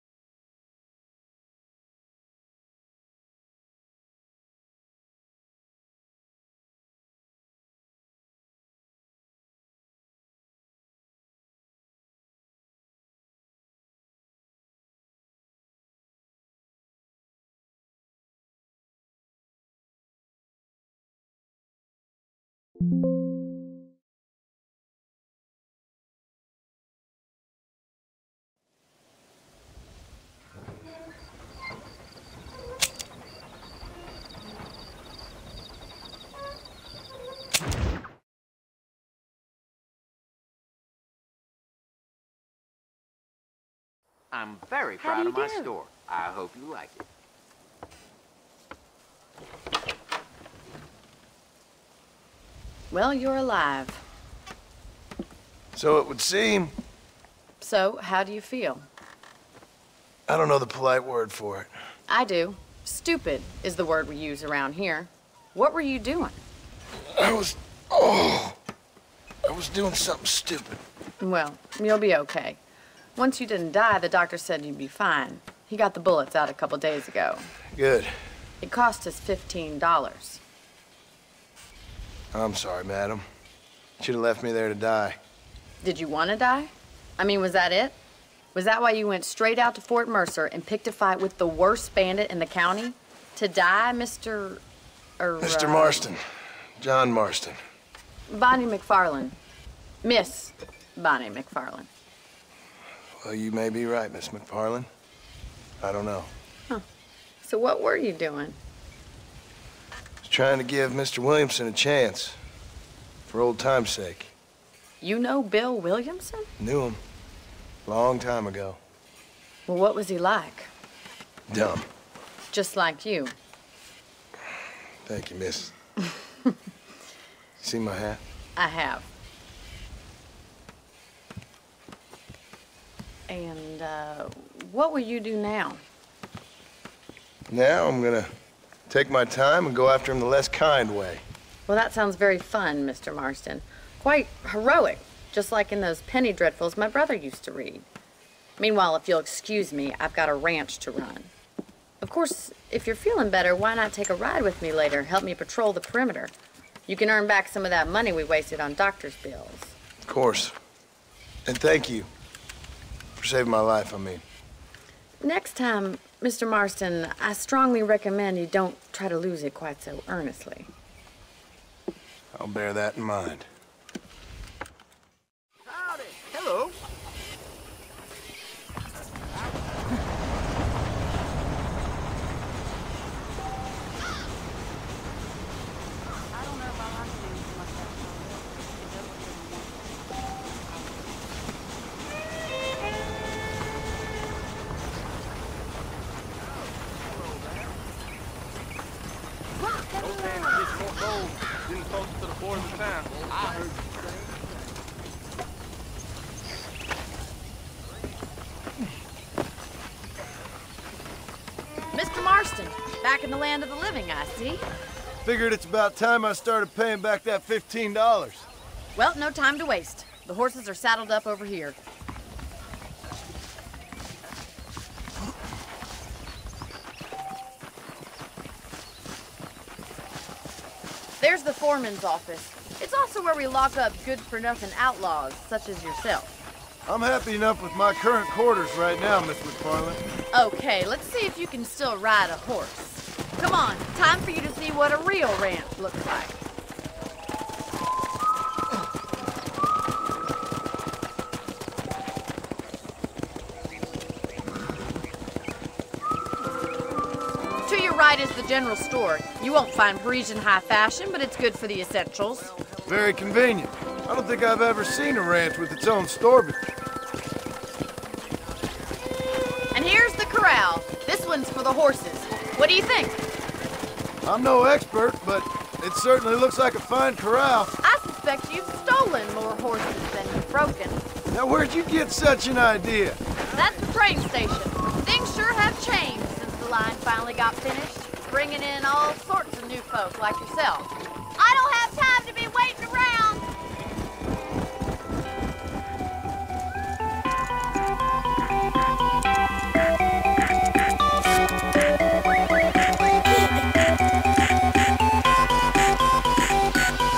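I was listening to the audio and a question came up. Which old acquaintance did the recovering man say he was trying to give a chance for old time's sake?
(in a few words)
Bill Williamson.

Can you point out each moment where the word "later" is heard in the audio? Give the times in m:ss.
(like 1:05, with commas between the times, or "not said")
2:34.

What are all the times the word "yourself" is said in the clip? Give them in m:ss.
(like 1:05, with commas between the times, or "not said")
3:55, 4:50.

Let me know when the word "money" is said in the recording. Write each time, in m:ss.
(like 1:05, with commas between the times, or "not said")
2:37.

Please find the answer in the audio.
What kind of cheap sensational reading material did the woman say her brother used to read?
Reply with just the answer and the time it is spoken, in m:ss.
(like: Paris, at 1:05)
penny dreadfuls, at 2:26.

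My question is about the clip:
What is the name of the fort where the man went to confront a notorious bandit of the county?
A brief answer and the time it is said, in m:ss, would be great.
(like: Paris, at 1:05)
Fort Mercer, at 1:29.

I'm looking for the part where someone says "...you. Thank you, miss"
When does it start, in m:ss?
2:03.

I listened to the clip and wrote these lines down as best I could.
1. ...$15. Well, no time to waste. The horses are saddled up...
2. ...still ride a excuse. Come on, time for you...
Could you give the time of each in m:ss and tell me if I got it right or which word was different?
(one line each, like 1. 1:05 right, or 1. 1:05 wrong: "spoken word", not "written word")
1. 3:37 right
2. 4:01 wrong: "horse", not "excuse".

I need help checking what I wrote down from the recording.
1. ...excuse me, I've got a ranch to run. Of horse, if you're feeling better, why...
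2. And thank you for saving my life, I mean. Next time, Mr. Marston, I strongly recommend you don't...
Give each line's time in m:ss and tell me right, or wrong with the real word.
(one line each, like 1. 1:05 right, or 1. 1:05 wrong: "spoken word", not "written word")
1. 2:29 wrong: "course", not "horse"
2. 2:41 right.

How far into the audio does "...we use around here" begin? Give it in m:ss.
1:04.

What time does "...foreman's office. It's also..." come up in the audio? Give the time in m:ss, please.
3:51.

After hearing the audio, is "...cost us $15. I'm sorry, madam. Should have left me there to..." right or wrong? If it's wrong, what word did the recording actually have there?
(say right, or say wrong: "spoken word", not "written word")
right.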